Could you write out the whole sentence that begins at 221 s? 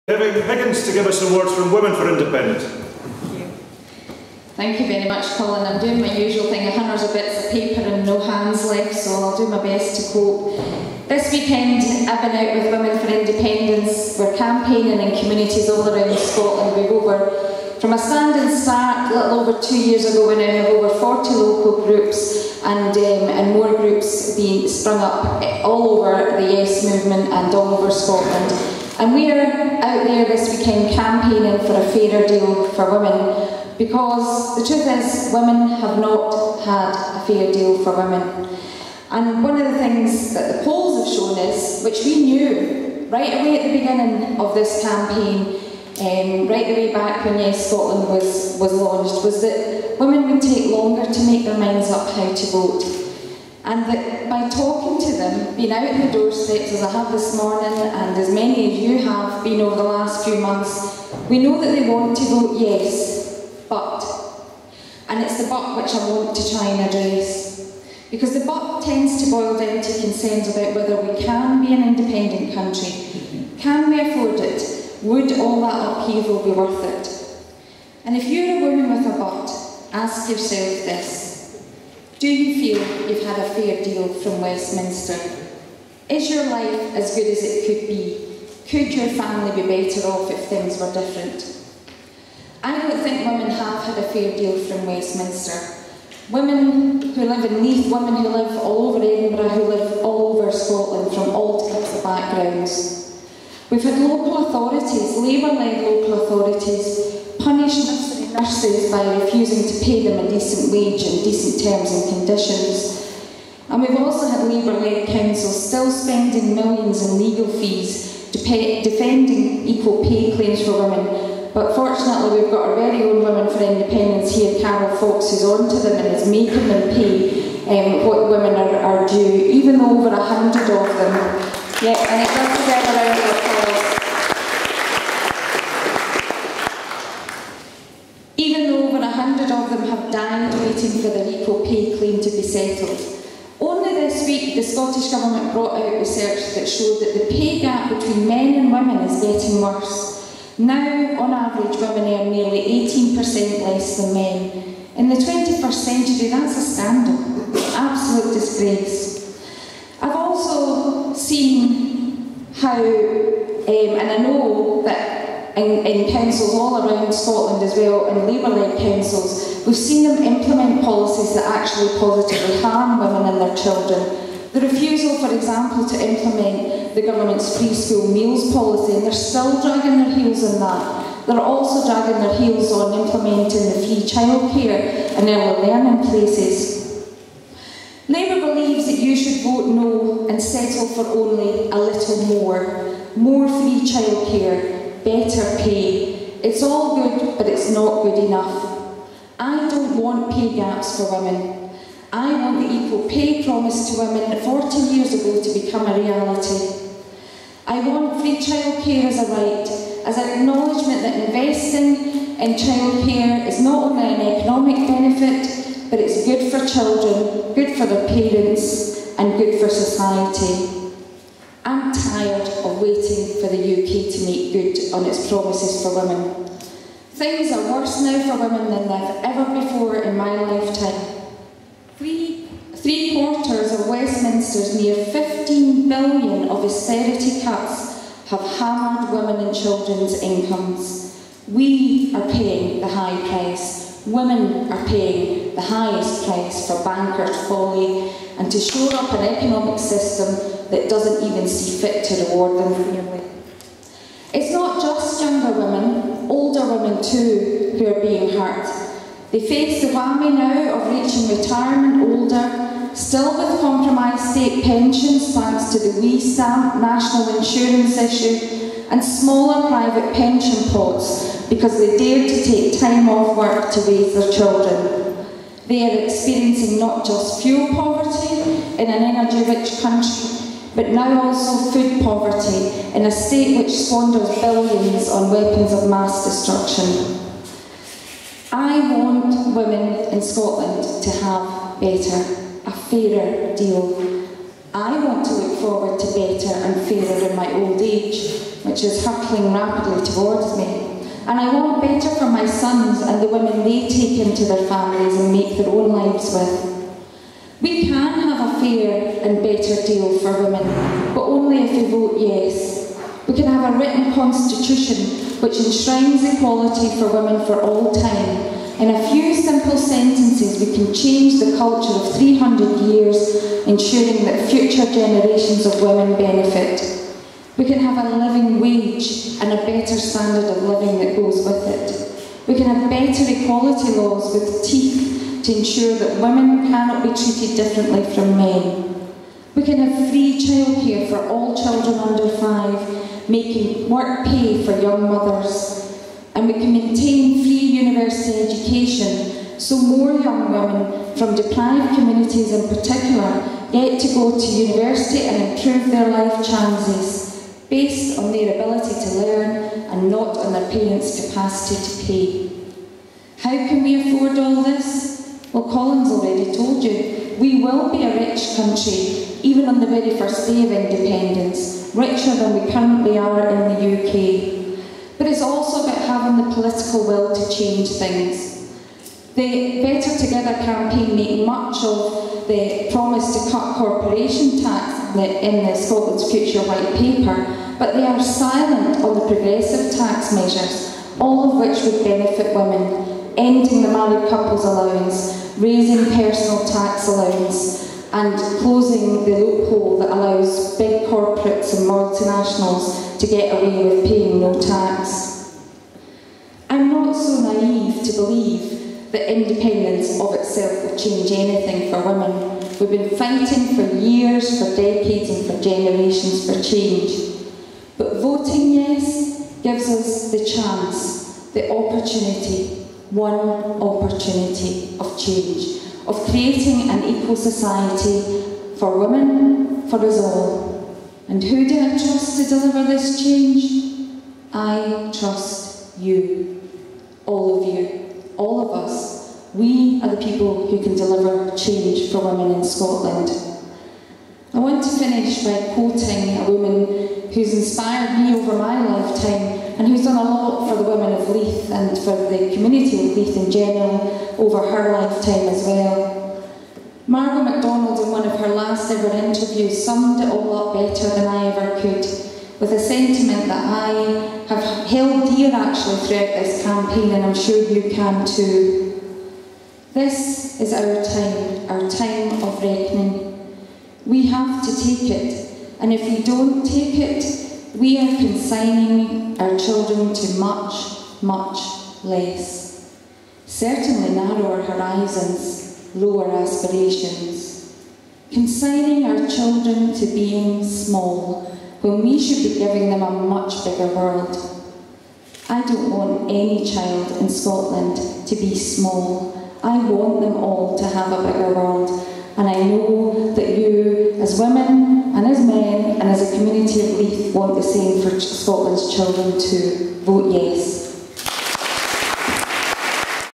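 I'm tired of waiting for the UK to make good on its promises for women.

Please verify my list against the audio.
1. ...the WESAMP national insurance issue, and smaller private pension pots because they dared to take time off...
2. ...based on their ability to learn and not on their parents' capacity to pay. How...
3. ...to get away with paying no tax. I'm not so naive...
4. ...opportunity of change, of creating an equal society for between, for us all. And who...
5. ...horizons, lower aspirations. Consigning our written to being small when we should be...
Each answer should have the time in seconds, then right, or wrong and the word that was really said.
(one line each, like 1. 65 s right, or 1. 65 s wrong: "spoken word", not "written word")
1. 265 s right
2. 357 s right
3. 403 s right
4. 423 s wrong: "women", not "between"
5. 484 s wrong: "children", not "written".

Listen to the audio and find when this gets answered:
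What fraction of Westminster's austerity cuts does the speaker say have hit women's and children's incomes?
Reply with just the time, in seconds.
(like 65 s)
232 s.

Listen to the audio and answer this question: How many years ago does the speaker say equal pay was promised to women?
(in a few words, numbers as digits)
40 years.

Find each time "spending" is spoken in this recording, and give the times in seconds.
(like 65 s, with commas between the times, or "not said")
115 s.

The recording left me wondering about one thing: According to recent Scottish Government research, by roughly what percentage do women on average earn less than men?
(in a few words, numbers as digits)
nearly 18%.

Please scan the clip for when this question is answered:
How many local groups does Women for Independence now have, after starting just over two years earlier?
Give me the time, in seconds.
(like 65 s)
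20 s.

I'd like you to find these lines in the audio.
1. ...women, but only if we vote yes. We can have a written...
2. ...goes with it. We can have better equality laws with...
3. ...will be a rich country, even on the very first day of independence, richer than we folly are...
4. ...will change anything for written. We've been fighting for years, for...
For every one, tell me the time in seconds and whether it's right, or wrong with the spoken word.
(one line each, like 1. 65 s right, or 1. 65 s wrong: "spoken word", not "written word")
1. 310 s right
2. 331 s right
3. 367 s wrong: "currently", not "folly"
4. 410 s wrong: "women", not "written".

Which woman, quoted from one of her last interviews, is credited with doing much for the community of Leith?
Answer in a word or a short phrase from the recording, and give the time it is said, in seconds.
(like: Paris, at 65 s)
Margo MacDonald, at 457 s.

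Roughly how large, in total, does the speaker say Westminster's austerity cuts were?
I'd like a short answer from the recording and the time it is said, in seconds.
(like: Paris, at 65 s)
15 billion, at 235 s.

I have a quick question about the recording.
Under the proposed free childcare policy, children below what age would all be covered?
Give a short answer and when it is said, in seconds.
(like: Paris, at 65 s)
under 5, at 341 s.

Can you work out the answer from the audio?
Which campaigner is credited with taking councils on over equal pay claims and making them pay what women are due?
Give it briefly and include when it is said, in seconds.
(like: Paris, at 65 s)
Carol Fox, at 124 s.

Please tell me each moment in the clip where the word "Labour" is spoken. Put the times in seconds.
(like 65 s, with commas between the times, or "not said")
105 s, 114 s, 168 s, 188 s.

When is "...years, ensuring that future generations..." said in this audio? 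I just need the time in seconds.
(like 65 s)
322 s.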